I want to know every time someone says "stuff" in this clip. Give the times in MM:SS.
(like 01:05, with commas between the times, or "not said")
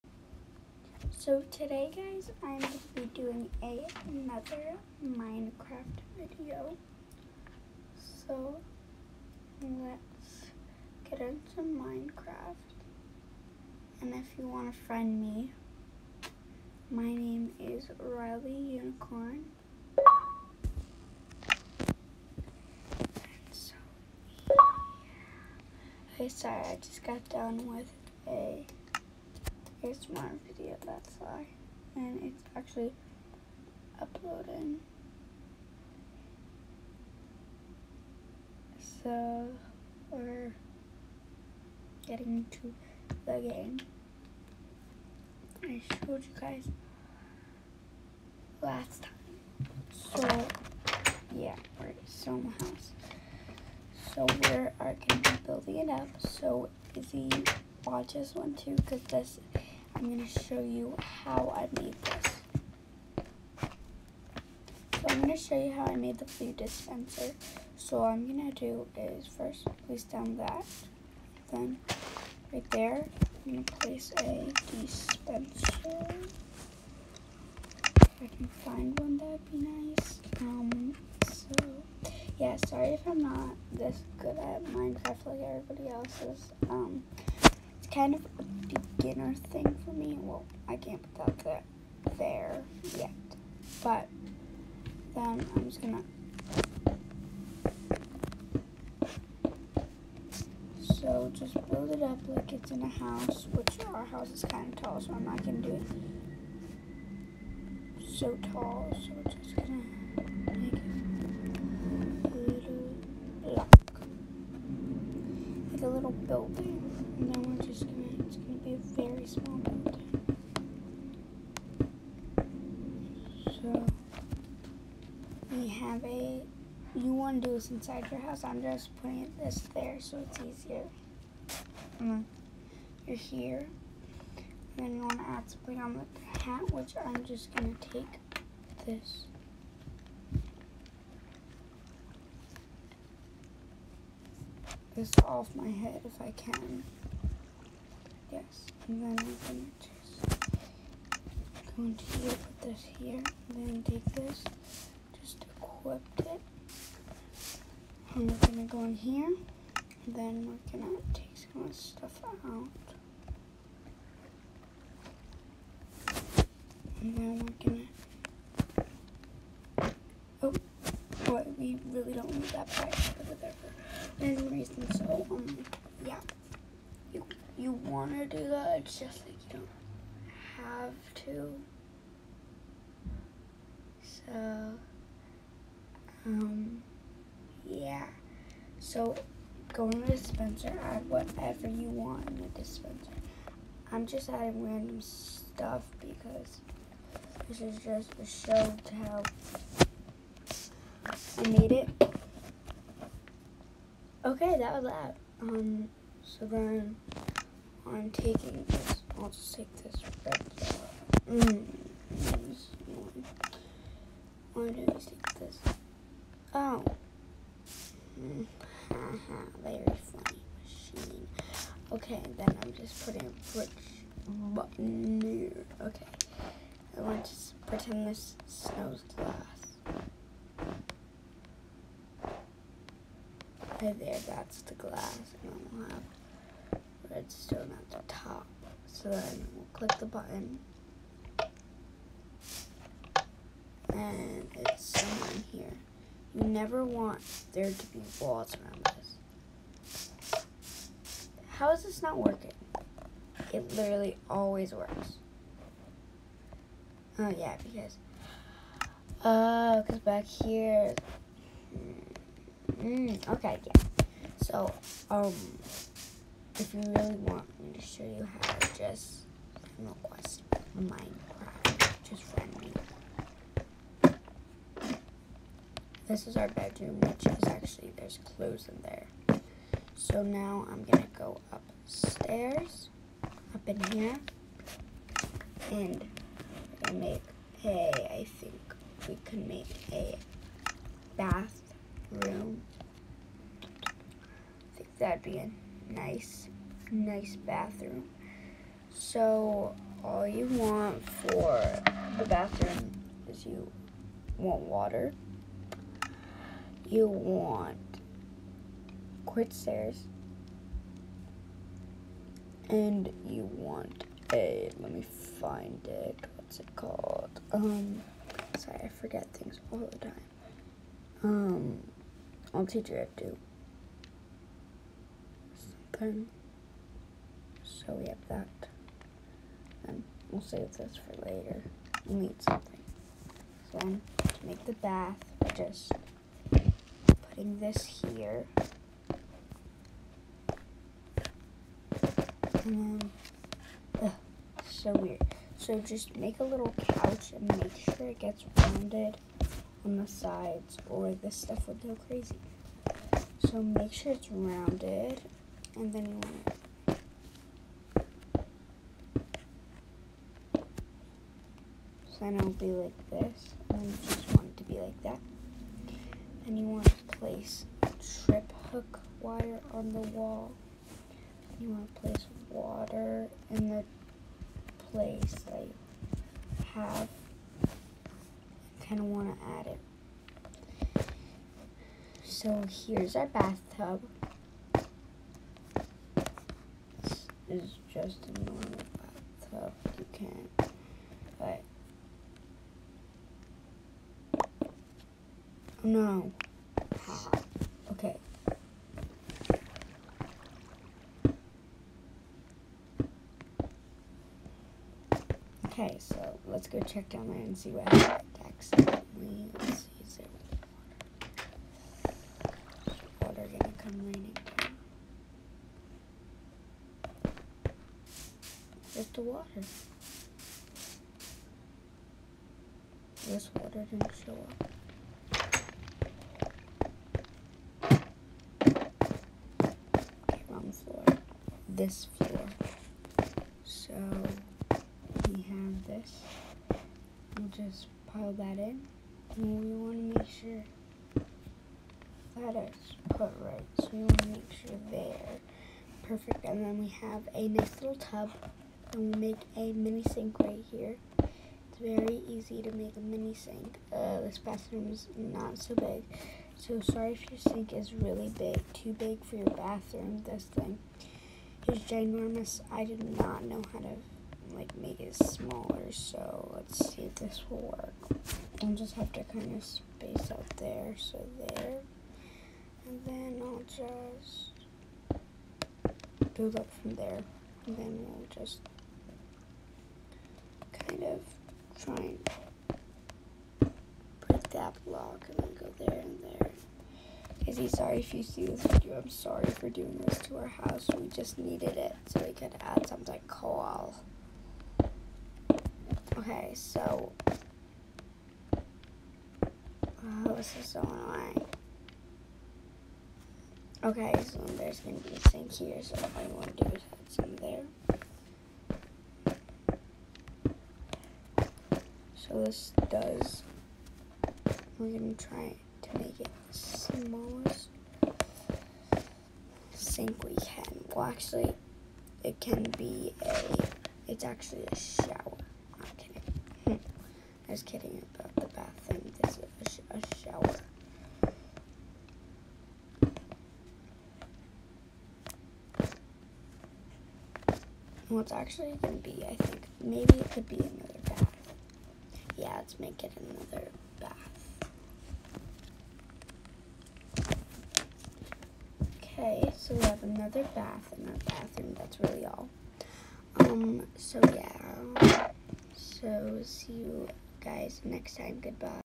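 02:41, 03:15, 05:51.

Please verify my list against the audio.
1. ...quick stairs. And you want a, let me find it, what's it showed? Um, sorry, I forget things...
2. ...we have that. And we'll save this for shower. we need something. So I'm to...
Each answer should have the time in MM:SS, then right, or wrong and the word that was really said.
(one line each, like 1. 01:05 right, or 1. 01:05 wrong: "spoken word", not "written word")
1. 05:09 wrong: "called", not "showed"
2. 05:27 wrong: "later", not "shower".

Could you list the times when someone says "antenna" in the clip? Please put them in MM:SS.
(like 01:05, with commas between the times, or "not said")
not said.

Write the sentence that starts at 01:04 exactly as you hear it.
So I'm going to show you how I made the food dispenser.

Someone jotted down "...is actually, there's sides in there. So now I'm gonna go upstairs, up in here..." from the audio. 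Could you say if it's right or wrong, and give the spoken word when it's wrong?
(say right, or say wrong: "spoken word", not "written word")
wrong: "clothes", not "sides".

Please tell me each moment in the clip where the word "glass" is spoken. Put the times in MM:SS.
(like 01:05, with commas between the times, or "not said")
03:49, 03:54.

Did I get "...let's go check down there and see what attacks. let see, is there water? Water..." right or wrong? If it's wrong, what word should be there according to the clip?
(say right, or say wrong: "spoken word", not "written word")
right.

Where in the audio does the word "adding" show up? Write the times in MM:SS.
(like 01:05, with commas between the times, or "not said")
03:14.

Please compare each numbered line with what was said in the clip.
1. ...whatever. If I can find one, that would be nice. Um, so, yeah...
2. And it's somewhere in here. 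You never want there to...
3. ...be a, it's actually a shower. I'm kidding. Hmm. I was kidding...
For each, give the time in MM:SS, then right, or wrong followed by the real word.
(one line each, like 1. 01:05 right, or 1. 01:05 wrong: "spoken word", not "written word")
1. 01:14 wrong: "dispenser", not "whatever"
2. 04:03 right
3. 08:42 right.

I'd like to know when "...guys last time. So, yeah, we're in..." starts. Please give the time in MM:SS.
00:46.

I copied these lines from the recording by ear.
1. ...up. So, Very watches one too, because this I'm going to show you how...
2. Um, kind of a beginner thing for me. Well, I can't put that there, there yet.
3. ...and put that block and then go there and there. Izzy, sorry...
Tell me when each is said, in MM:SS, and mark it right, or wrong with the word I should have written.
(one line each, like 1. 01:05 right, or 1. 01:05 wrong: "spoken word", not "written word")
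1. 00:55 wrong: "Izzy", not "Very"
2. 01:26 right
3. 08:01 right.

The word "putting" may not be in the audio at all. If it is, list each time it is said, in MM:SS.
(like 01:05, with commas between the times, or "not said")
02:08, 03:43, 05:37.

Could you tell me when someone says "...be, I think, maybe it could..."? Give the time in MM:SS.
08:59.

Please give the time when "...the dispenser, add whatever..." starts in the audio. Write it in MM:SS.
03:10.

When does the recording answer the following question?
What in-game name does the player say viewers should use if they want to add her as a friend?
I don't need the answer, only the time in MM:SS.
00:17.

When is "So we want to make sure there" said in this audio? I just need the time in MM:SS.
07:23.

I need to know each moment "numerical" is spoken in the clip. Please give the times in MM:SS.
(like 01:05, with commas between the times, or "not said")
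not said.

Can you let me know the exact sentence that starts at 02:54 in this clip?
reason so um you want to do that.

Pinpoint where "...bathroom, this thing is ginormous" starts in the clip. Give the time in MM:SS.
07:39.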